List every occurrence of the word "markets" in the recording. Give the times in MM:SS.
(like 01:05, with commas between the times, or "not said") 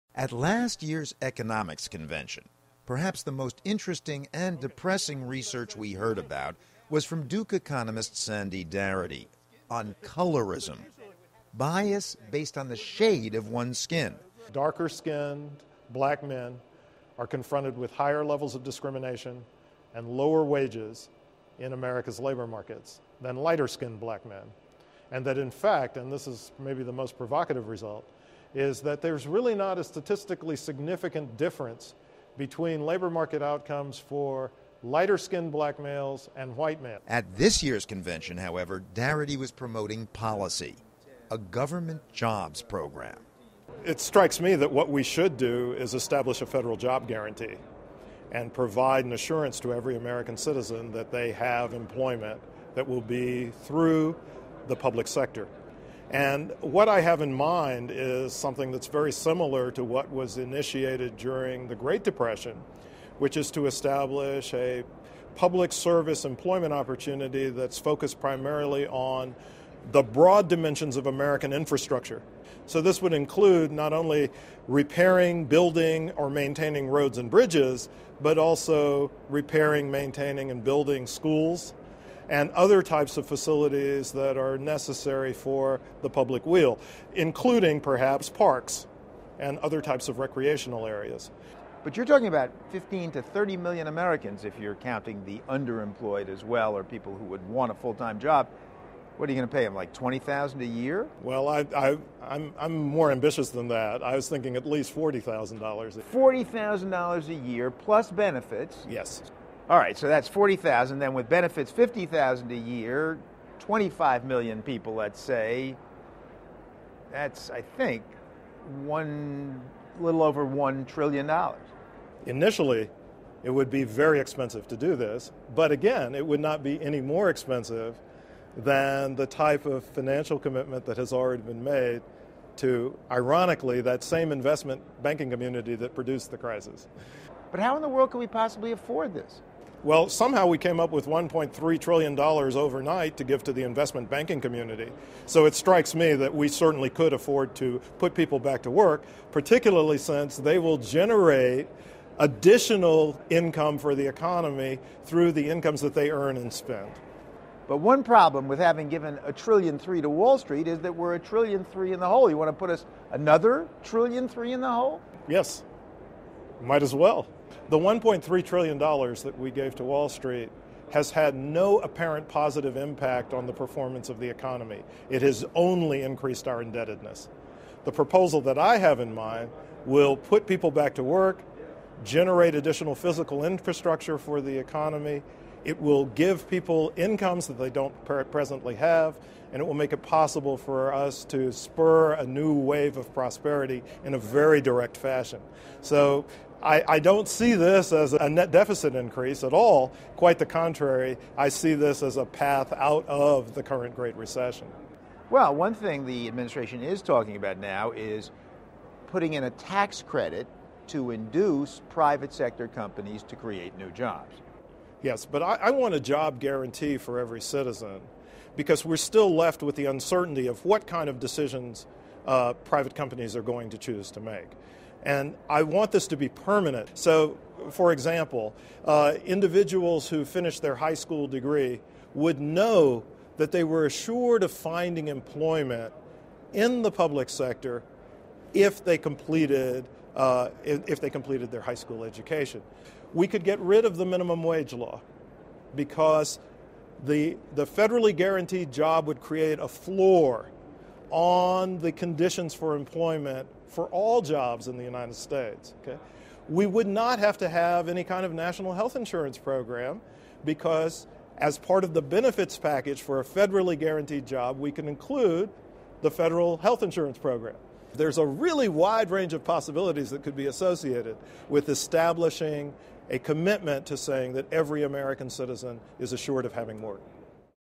00:22, 00:33.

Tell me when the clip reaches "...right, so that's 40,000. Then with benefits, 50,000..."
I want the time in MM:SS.
01:49.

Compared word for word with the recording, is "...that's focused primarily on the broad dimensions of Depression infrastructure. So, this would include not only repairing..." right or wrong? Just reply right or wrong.
wrong.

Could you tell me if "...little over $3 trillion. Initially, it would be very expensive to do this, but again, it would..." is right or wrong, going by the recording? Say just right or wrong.
wrong.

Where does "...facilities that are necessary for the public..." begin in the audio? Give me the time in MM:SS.
01:23.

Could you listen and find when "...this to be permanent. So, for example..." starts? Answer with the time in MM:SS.
03:45.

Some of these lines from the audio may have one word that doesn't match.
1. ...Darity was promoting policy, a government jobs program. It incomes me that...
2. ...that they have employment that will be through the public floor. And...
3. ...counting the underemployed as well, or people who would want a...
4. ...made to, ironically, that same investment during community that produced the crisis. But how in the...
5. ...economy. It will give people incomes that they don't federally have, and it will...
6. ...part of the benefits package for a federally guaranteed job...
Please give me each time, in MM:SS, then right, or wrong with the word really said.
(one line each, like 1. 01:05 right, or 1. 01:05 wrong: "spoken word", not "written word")
1. 00:38 wrong: "strikes", not "incomes"
2. 00:50 wrong: "sector", not "floor"
3. 01:34 right
4. 02:11 wrong: "banking", not "during"
5. 03:04 wrong: "presently", not "federally"
6. 04:21 right.